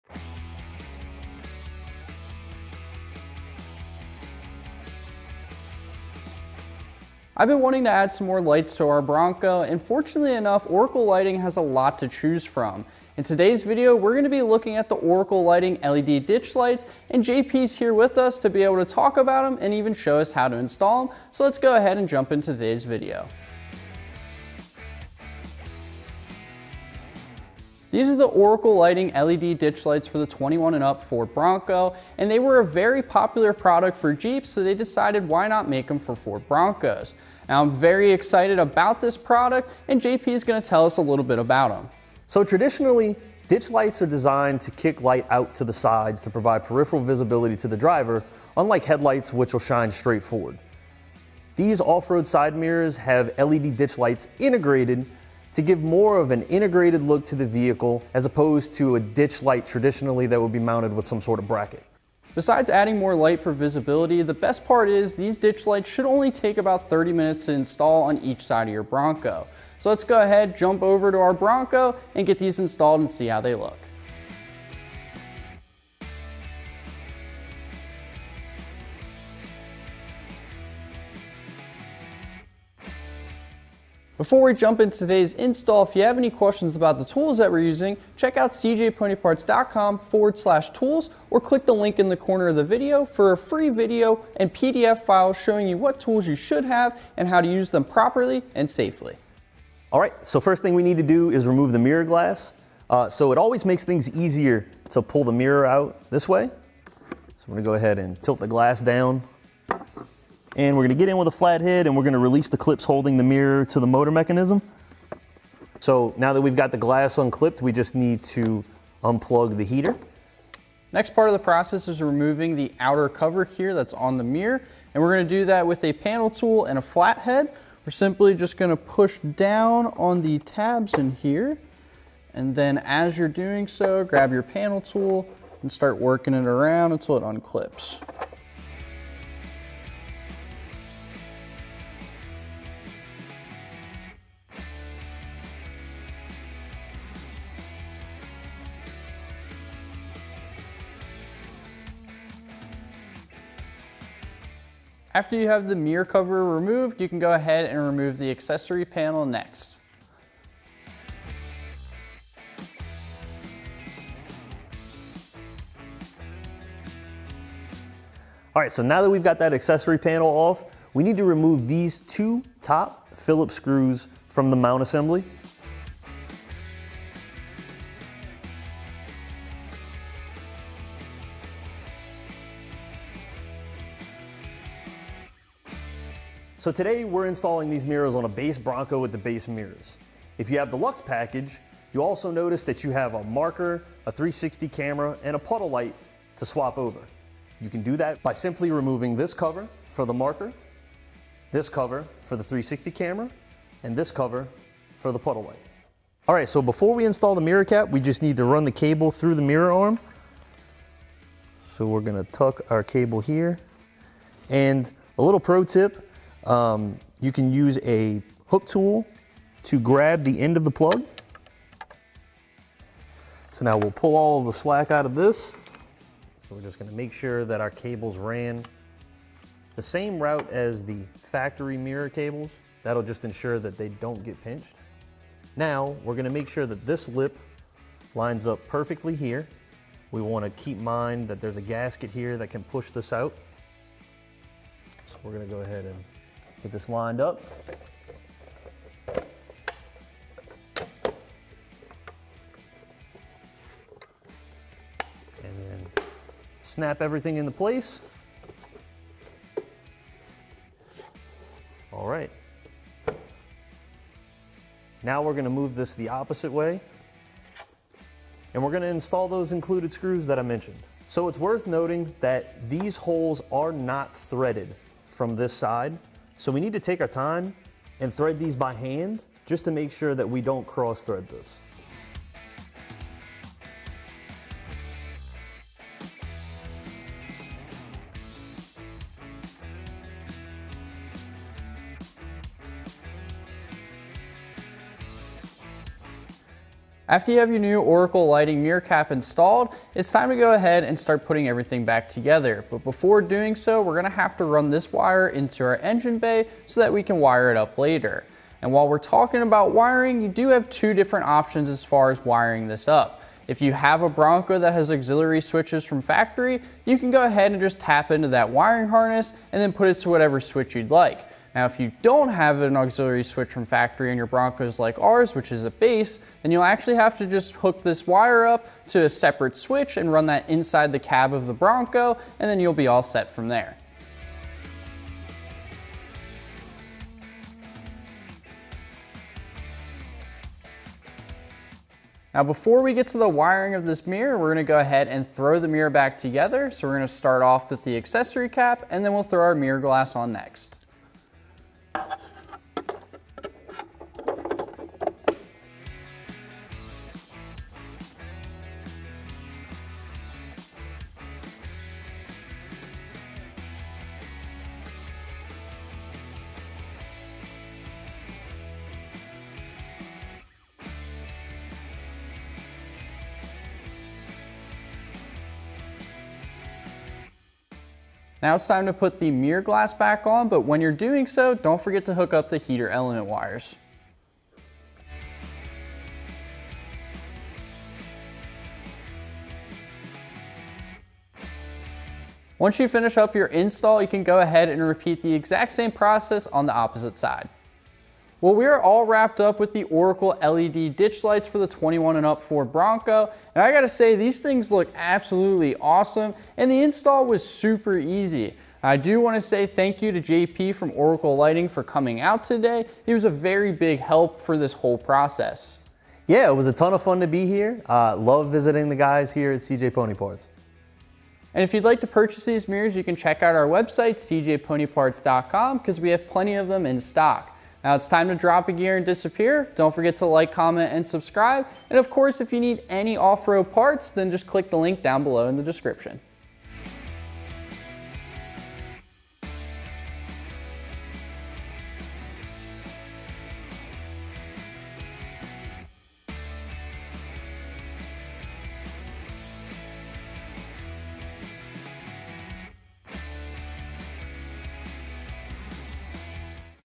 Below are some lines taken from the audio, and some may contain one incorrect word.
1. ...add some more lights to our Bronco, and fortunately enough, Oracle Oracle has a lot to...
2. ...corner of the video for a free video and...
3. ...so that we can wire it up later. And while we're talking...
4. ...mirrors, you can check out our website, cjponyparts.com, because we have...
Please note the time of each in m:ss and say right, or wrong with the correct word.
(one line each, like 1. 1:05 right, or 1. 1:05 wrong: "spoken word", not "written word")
1. 0:07 wrong: "Lighting", not "Oracle"
2. 1:32 right
3. 5:06 right
4. 7:02 right.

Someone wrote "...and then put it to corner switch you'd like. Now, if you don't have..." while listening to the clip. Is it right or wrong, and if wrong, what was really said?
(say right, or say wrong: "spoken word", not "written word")
wrong: "whatever", not "corner".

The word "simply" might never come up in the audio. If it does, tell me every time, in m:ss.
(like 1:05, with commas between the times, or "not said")
2:07, 3:18.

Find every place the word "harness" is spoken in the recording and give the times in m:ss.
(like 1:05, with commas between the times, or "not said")
5:18.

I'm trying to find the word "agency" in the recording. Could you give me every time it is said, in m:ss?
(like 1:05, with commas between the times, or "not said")
not said.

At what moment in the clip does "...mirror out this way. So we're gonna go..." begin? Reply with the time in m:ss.
1:45.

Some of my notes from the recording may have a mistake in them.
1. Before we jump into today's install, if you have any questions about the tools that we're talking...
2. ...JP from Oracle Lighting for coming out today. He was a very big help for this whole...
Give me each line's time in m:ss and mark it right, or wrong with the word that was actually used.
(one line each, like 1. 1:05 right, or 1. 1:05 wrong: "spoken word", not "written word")
1. 1:24 wrong: "using", not "talking"
2. 6:50 right.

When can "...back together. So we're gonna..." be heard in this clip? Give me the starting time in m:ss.
5:45.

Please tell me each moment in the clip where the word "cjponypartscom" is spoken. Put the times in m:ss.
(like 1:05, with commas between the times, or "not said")
1:28, 7:04.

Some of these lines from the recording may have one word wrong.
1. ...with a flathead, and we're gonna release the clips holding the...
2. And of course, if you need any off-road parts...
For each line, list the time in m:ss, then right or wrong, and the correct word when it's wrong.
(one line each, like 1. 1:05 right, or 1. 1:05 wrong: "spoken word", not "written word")
1. 1:51 right
2. 7:11 right.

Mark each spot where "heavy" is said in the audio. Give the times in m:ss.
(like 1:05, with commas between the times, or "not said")
not said.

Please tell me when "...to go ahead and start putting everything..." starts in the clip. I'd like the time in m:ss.
5:00.